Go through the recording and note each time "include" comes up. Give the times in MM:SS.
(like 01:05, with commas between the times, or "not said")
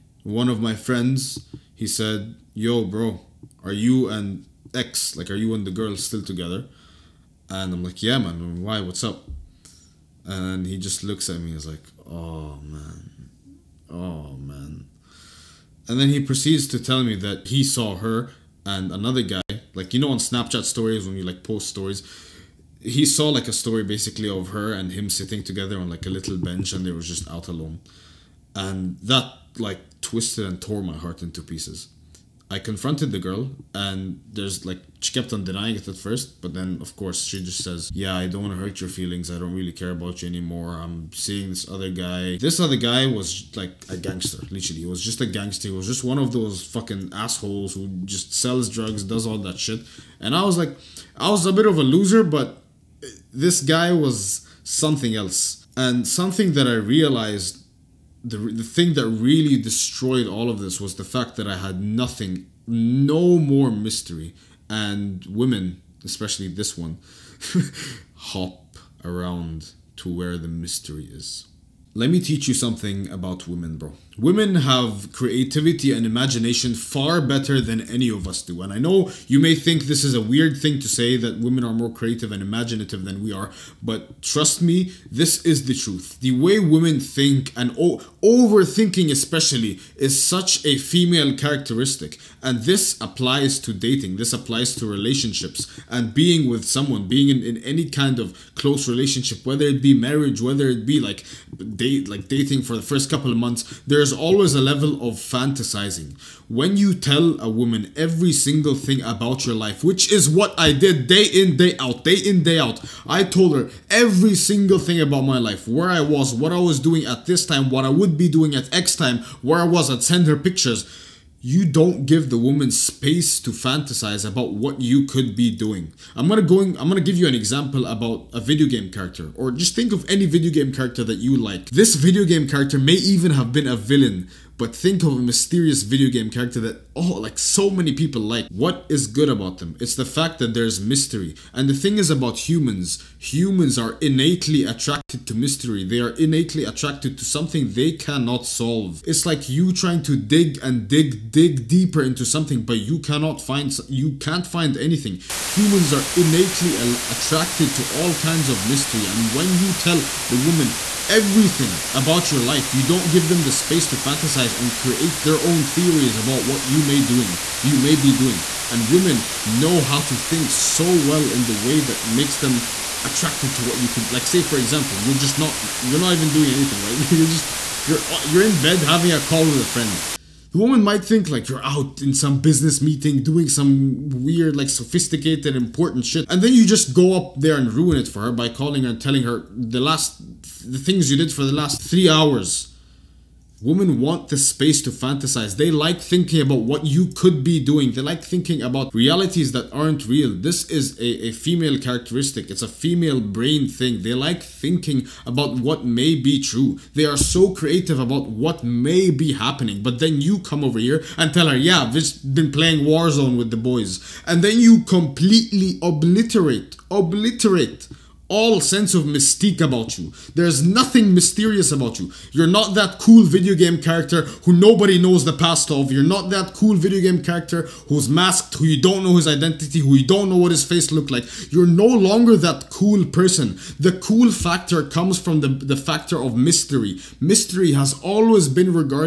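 not said.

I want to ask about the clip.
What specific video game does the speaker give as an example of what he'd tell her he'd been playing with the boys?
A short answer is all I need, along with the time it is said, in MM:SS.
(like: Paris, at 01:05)
Warzone, at 03:32.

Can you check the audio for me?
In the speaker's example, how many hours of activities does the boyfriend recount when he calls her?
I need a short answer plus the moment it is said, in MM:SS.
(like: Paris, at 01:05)
3, at 03:11.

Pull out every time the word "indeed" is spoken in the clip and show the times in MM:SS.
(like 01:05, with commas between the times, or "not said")
not said.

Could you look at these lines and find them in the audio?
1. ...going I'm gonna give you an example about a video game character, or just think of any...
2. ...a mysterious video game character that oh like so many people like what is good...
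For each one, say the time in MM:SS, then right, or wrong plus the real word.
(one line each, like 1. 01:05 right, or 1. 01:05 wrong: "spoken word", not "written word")
1. 02:06 right
2. 02:15 right.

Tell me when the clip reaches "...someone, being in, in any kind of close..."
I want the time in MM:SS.
01:36.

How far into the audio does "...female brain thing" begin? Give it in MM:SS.
03:22.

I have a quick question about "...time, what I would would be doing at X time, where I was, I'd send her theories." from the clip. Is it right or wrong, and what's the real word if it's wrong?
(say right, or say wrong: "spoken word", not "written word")
wrong: "pictures", not "theories".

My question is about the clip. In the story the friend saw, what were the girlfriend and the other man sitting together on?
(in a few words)
a little bench.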